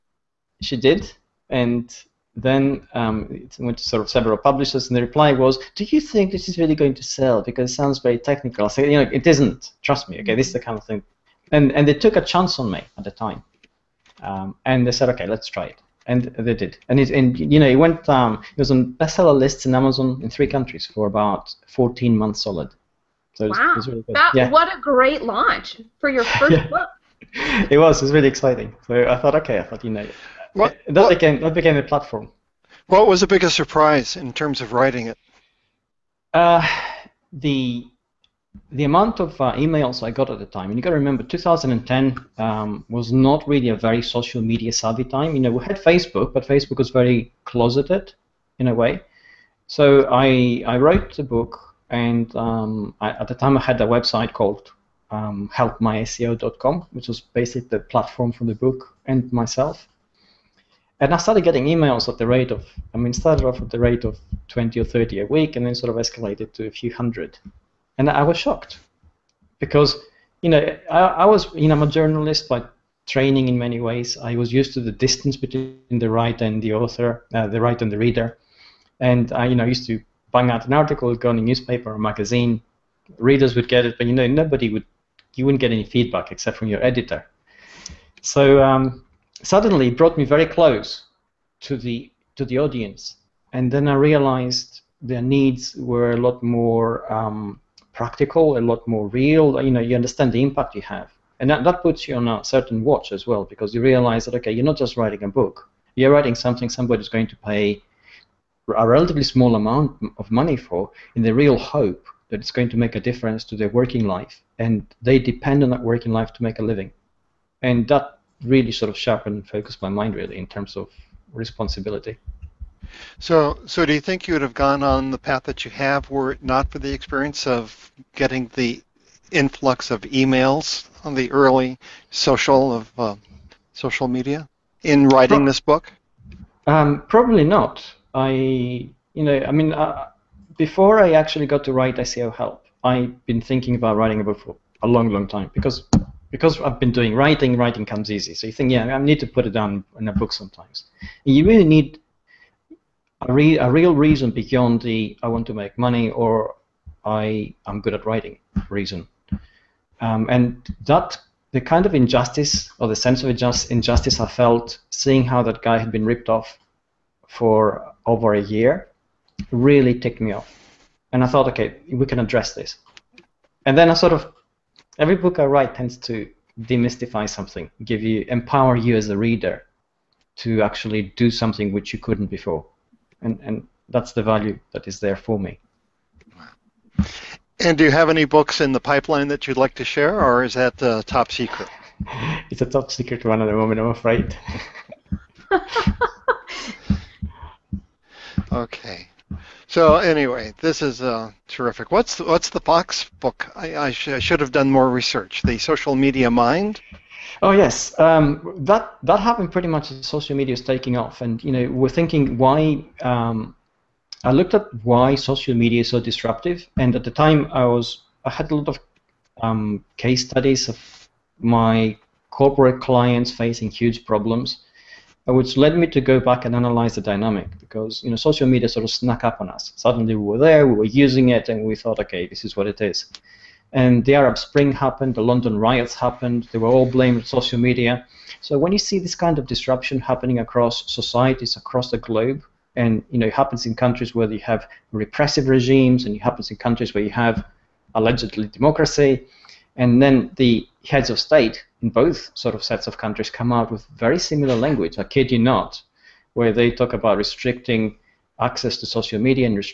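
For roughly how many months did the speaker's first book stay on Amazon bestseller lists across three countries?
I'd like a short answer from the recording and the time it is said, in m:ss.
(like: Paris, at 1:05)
14 months, at 0:21.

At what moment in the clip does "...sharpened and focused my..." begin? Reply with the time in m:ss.
1:58.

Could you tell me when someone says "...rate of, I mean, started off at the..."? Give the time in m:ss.
1:02.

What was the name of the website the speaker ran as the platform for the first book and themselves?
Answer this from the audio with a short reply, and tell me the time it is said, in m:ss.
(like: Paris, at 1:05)
helpmyseo.com, at 0:55.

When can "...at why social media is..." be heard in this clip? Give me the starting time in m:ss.
3:34.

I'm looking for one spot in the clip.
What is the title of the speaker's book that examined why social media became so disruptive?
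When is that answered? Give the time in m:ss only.
3:25.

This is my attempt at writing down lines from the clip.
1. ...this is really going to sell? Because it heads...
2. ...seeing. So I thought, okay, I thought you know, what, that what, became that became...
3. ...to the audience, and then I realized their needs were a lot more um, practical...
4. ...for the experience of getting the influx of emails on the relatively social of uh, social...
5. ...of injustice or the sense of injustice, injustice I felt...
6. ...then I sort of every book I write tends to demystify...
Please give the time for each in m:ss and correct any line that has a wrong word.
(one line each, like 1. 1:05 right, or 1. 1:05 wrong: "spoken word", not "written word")
1. 0:06 wrong: "sounds", not "heads"
2. 0:28 wrong: "exciting", not "seeing"
3. 1:32 right
4. 2:06 wrong: "early", not "relatively"
5. 2:41 right
6. 2:53 right.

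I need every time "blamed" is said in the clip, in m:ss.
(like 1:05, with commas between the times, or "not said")
3:56.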